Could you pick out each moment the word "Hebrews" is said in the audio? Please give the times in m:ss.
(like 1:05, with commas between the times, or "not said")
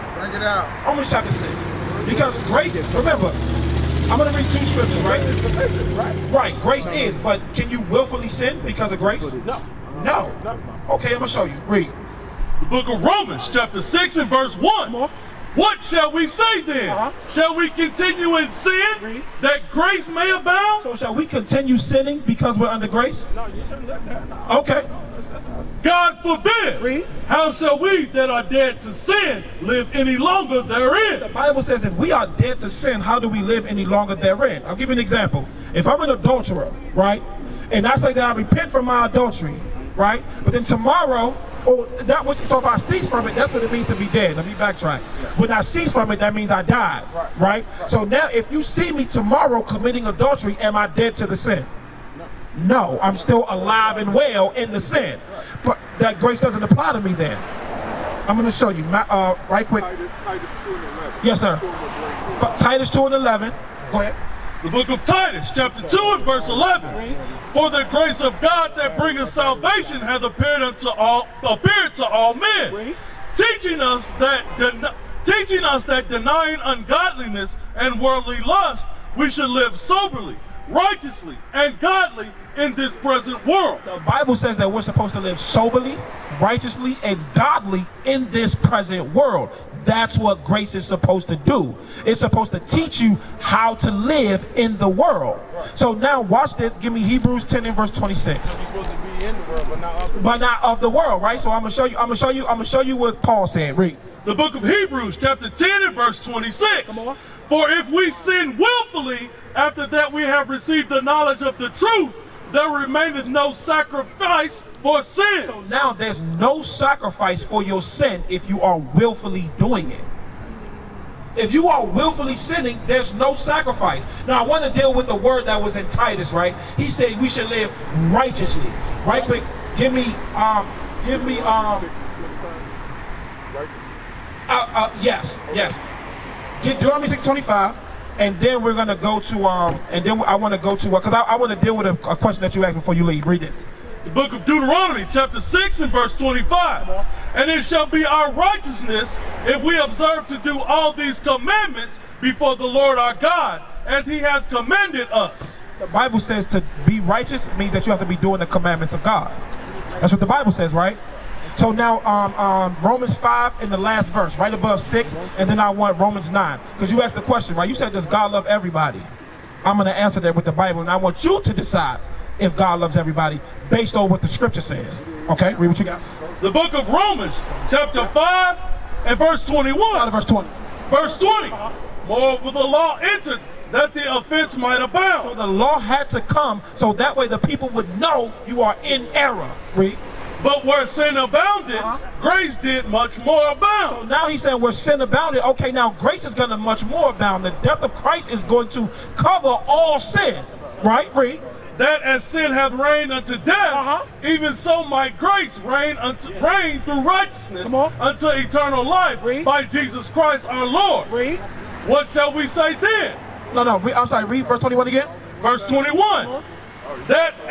1:37, 1:44.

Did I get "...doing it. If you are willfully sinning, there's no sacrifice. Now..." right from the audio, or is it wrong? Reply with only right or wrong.
right.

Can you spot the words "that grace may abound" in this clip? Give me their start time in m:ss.
0:19.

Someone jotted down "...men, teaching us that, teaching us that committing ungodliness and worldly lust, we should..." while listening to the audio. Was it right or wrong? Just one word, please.
wrong.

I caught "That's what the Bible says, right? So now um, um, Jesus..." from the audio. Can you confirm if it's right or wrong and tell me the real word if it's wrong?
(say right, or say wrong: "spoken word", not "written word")
wrong: "Romans", not "Jesus".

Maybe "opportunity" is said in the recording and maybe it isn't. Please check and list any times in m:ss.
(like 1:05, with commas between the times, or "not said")
not said.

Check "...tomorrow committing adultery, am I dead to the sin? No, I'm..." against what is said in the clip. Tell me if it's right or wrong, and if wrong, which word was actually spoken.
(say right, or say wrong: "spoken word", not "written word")
right.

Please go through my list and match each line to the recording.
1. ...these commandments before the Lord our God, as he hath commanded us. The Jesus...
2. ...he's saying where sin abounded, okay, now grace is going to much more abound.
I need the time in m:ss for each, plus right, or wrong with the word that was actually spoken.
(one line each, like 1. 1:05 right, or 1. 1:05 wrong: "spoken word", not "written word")
1. 2:30 wrong: "Bible", not "Jesus"
2. 3:14 right.